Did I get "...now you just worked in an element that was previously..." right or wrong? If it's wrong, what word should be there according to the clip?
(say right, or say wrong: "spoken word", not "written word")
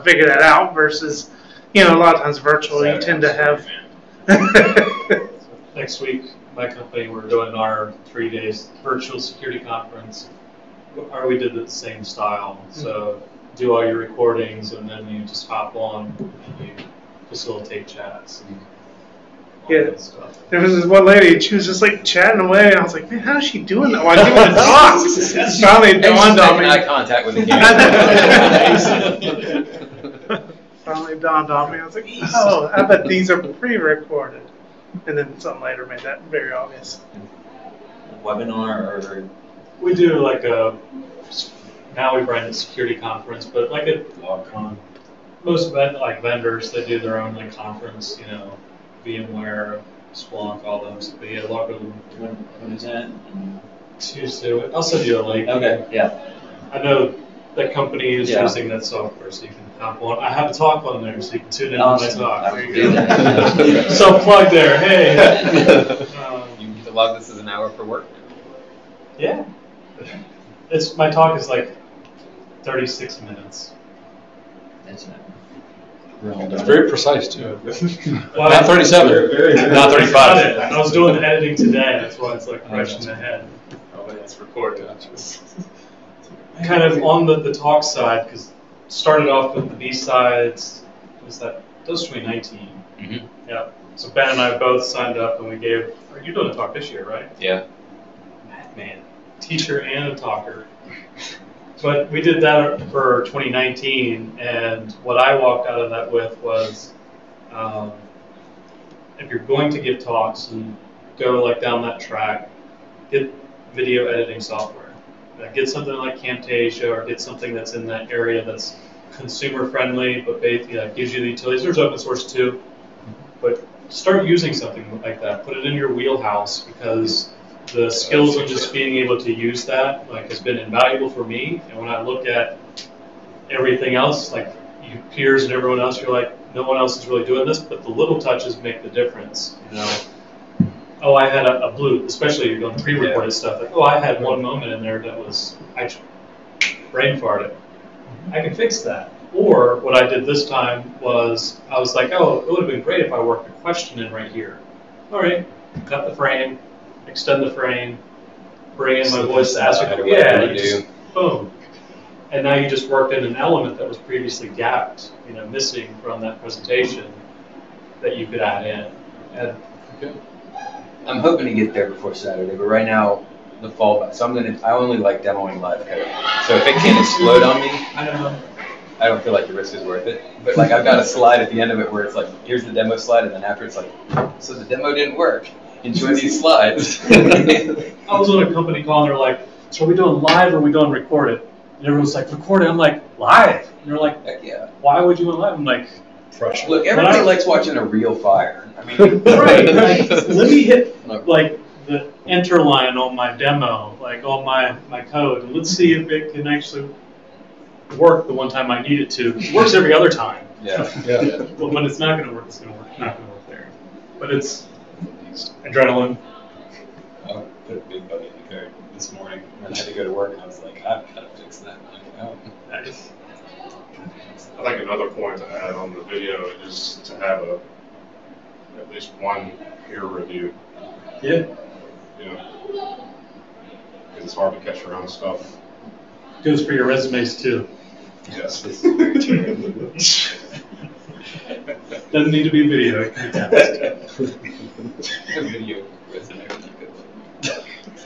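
right.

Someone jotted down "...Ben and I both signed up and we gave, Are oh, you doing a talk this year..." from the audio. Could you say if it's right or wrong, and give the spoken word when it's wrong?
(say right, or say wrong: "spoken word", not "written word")
right.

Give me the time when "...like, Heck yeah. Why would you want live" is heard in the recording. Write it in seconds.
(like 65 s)
193 s.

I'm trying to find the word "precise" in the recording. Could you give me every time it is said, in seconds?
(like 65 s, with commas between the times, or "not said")
76 s.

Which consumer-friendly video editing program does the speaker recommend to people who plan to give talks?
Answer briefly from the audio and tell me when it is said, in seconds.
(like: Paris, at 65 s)
Camtasia, at 116 s.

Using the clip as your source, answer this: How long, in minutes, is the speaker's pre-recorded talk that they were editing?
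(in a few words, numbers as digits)
36.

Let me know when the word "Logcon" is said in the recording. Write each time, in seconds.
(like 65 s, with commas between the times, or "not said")
44 s, 51 s.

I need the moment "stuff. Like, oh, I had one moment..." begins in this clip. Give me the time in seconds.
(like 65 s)
143 s.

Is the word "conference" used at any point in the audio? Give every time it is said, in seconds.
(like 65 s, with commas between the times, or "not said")
9 s, 42 s, 47 s.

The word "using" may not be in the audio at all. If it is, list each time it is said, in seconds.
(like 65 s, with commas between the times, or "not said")
58 s, 124 s.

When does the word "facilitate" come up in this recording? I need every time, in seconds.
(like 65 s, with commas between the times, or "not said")
17 s.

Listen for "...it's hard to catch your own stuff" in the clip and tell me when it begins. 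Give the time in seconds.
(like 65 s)
234 s.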